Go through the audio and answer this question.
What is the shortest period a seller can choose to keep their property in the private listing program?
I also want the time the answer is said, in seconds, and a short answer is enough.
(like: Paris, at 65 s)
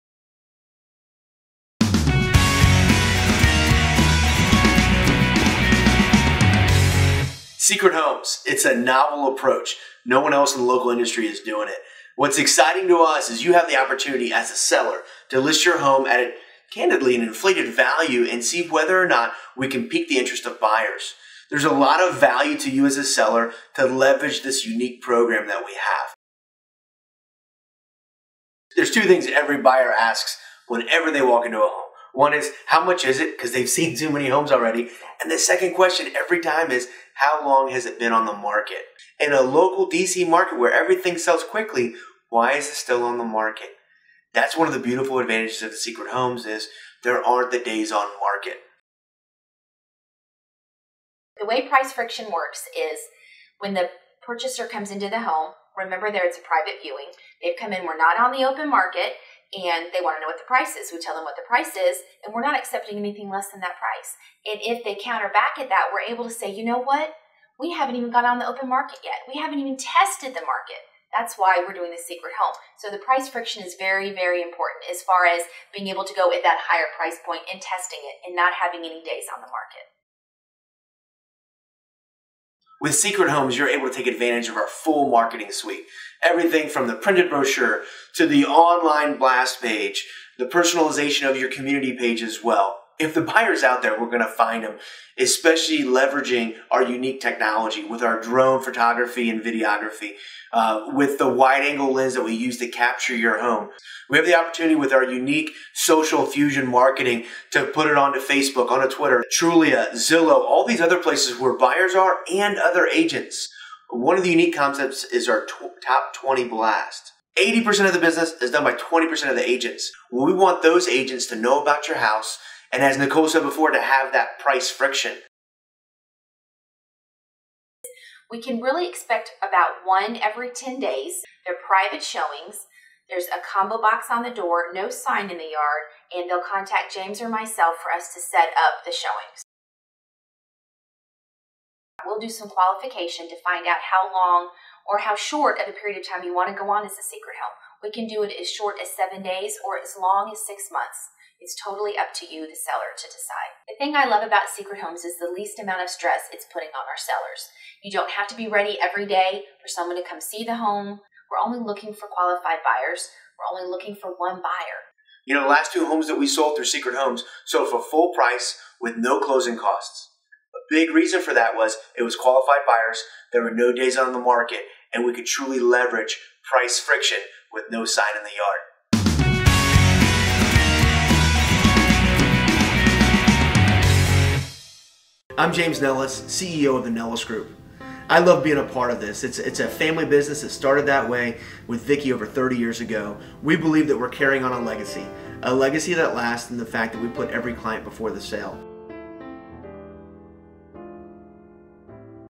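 7 days, at 148 s.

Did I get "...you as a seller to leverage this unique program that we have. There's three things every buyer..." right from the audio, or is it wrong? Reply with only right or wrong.
wrong.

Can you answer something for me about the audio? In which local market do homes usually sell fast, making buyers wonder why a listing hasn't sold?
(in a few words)
DC.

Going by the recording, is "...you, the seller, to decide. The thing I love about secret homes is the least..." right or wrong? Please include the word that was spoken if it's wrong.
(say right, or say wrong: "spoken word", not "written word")
right.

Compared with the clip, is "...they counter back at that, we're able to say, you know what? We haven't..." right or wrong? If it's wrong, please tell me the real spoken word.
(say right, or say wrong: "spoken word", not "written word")
right.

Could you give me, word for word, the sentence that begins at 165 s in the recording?
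You know, the last two homes that we sold through Secret Homes sold for full price with no closing costs.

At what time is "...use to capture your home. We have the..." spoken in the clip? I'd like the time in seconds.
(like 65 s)
102 s.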